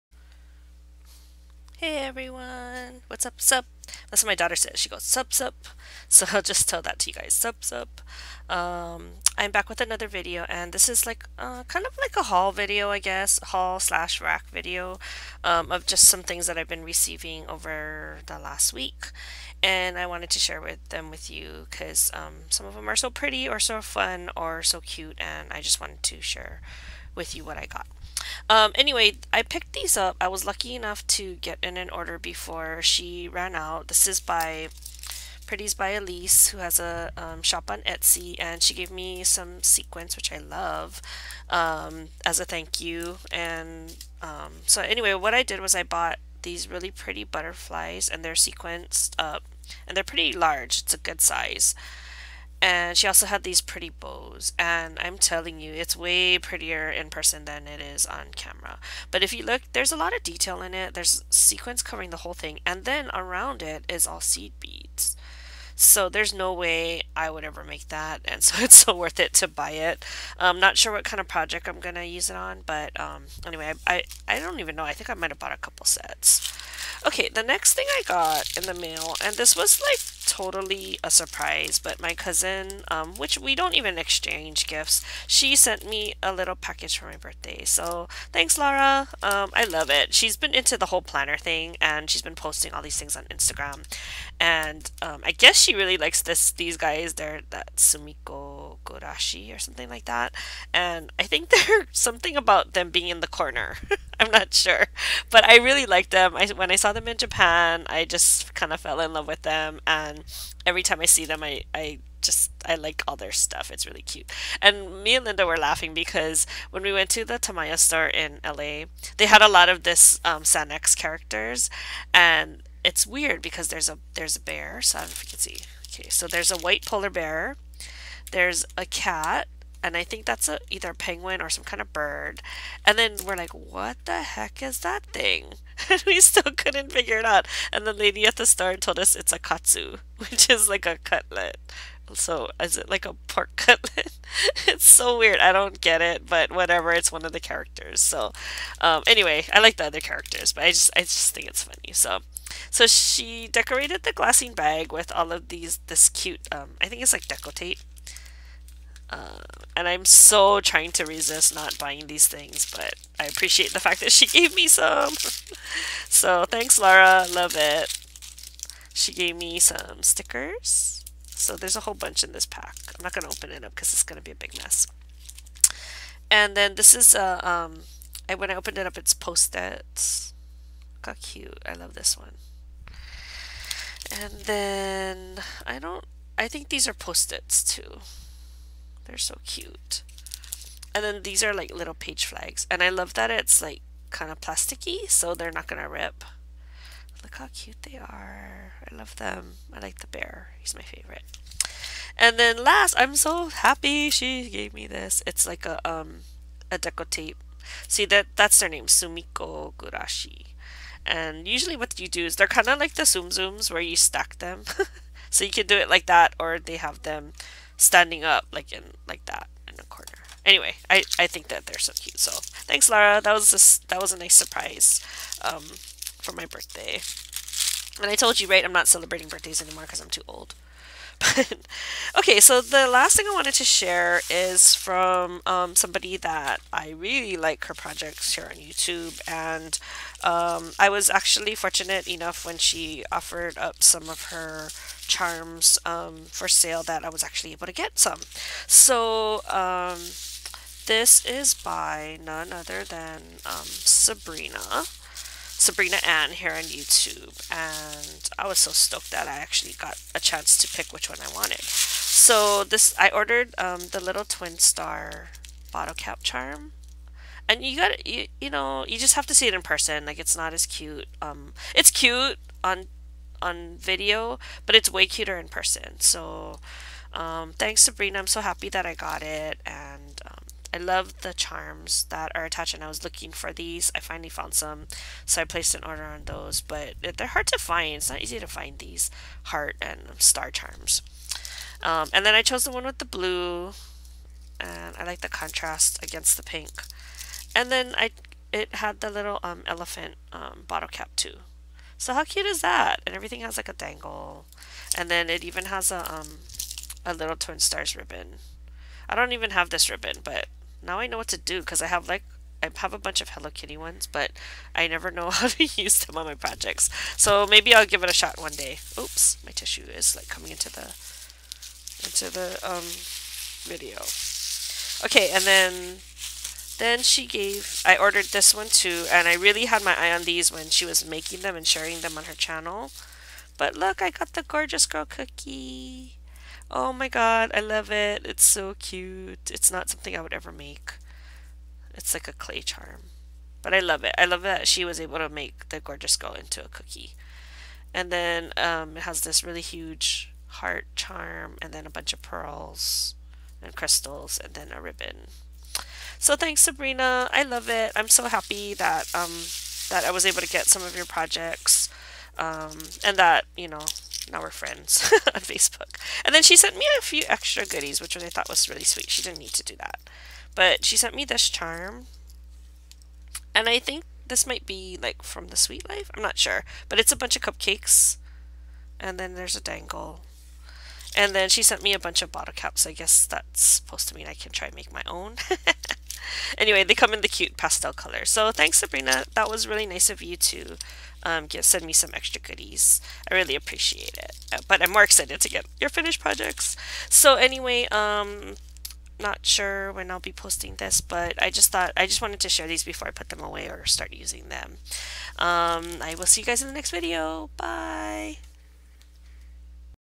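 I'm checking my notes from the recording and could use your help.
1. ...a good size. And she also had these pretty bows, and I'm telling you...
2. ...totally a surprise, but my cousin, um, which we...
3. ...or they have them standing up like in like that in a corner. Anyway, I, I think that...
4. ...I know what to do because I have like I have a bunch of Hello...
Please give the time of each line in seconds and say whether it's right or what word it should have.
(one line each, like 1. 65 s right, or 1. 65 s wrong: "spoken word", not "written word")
1. 50 s right
2. 80 s right
3. 216 s right
4. 310 s right.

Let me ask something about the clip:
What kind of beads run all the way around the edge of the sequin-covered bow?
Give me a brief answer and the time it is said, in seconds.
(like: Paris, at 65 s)
seed beads, at 64 s.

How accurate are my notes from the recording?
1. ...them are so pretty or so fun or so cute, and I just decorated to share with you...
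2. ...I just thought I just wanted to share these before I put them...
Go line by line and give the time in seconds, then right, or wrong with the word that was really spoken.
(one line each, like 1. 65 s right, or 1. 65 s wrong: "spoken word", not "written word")
1. 22 s wrong: "wanted", not "decorated"
2. 401 s right.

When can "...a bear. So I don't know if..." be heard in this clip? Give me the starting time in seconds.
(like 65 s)
124 s.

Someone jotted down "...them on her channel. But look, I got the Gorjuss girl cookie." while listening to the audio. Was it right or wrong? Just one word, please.
right.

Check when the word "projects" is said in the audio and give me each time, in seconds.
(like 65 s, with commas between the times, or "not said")
71 s, 237 s, 316 s, 361 s, 396 s.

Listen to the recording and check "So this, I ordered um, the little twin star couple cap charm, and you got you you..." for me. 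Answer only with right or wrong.
wrong.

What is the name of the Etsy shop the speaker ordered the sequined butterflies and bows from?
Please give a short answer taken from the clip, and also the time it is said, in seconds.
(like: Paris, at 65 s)
Pretties by Alease, at 35 s.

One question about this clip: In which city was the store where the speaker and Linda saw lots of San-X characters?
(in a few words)
LA.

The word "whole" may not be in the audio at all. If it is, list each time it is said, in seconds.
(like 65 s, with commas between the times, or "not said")
62 s, 90 s, 171 s.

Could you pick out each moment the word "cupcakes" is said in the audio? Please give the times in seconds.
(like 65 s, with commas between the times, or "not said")
377 s.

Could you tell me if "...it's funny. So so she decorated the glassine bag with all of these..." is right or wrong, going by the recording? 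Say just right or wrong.
right.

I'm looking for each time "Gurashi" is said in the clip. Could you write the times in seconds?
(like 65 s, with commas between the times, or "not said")
98 s, 209 s.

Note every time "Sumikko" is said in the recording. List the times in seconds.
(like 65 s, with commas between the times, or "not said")
97 s, 208 s.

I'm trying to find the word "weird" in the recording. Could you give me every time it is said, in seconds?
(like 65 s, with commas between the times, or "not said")
123 s, 145 s.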